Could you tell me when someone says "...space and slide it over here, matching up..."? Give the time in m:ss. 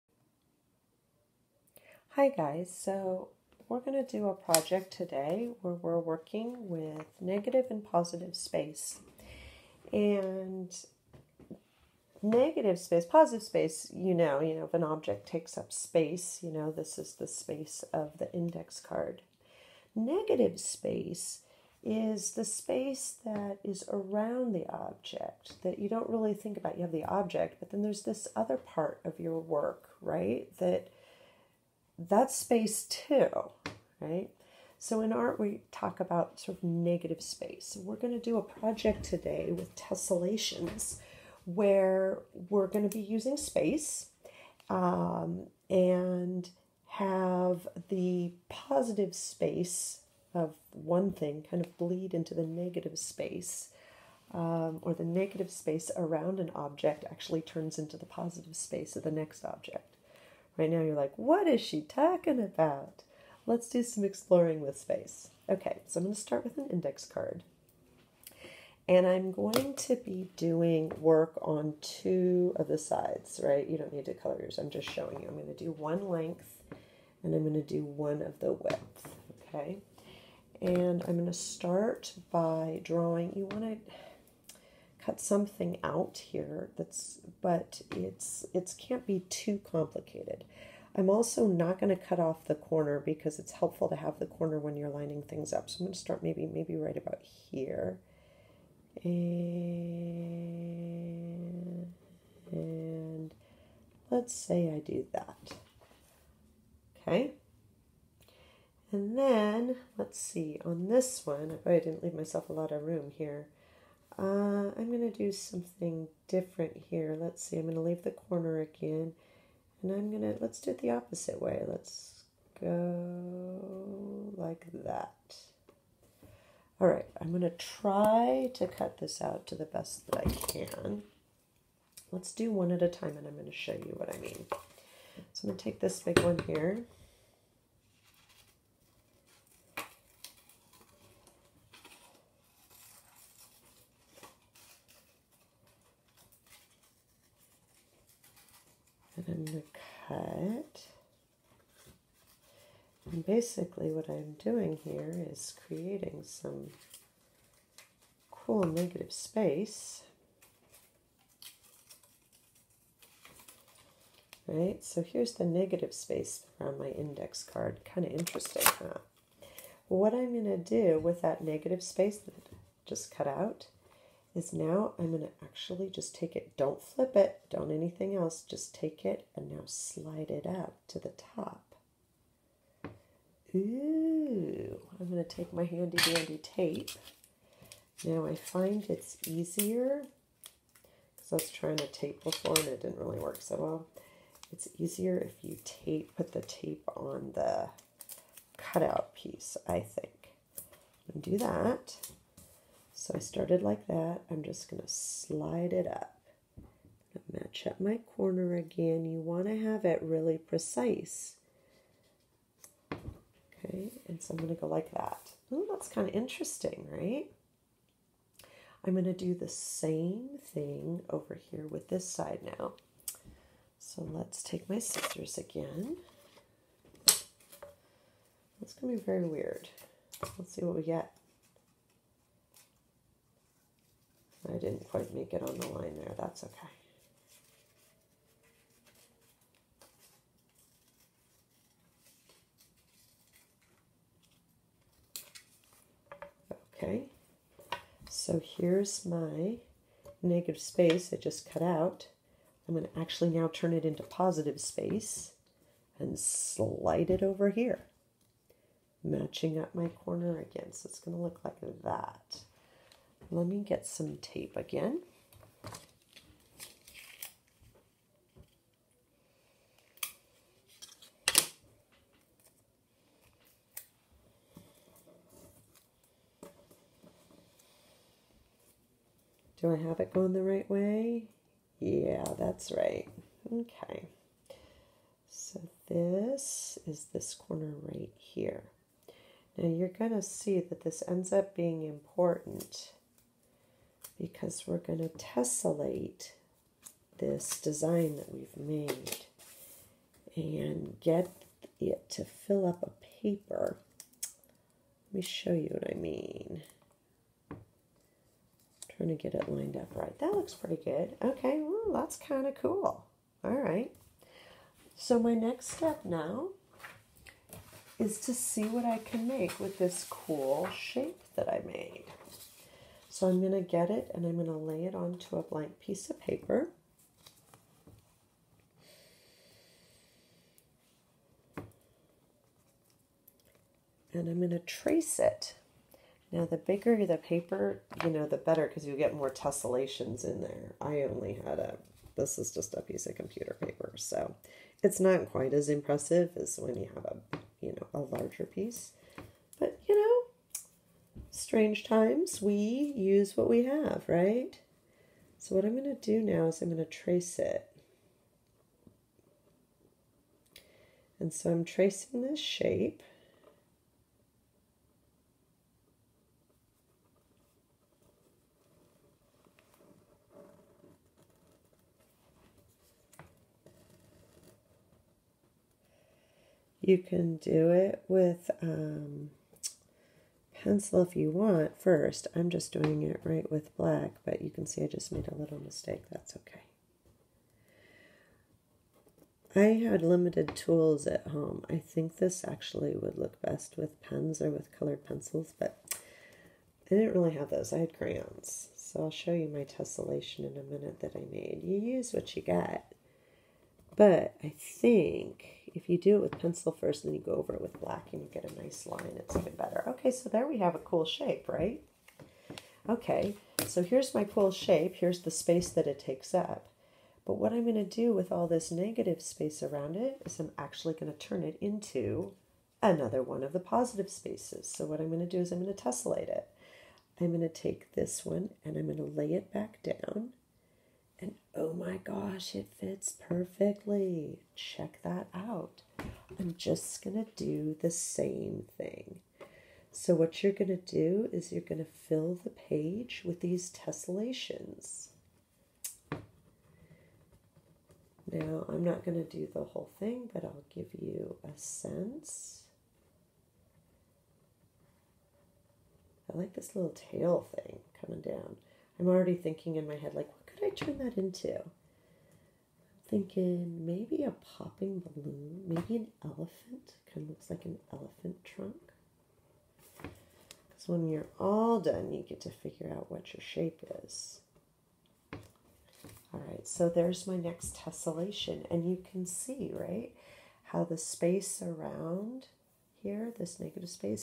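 4:14.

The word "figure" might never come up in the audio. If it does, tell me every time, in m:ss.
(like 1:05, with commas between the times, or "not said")
7:52.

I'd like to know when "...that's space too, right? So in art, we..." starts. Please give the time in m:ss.
0:32.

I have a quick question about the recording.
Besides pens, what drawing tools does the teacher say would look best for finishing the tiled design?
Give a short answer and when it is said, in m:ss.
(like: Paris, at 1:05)
Colored pencils, at 6:34.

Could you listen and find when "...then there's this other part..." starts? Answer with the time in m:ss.
0:27.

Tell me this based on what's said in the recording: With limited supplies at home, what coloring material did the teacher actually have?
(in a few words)
Crayons.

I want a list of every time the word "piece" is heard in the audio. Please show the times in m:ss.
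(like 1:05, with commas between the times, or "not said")
3:19, 5:25, 5:42, 5:48.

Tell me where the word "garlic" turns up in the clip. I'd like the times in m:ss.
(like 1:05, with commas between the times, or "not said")
not said.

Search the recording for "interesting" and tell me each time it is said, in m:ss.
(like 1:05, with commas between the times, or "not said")
2:48, 3:36.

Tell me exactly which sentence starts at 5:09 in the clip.
Trying to get it lined up right.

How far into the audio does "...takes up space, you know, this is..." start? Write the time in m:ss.
0:15.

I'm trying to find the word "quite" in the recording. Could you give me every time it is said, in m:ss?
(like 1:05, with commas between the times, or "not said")
3:54, 5:45.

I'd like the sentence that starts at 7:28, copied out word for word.
Now, I'm not going to do the whole thing, but I'll give you a sense.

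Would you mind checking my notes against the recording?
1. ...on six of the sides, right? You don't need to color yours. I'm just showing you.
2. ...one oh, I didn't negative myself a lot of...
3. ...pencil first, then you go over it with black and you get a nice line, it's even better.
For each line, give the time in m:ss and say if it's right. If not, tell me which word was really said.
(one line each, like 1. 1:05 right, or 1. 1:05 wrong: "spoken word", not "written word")
1. 1:11 wrong: "two", not "six"
2. 1:51 wrong: "leave", not "negative"
3. 6:46 right.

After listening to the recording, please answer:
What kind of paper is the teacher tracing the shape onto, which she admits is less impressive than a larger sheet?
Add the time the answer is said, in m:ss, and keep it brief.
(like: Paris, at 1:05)
Computer paper, at 5:43.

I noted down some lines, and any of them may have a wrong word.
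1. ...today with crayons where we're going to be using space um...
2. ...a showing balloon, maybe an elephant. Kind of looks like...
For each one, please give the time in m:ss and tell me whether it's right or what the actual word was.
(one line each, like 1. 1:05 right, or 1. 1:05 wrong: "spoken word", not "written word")
1. 0:39 wrong: "tessellations", not "crayons"
2. 7:44 wrong: "popping", not "showing".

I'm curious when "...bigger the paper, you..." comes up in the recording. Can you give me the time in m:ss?
5:36.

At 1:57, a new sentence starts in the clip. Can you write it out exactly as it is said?
Let's see, I'm going to leave the corner again.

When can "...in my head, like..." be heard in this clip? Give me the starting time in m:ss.
7:39.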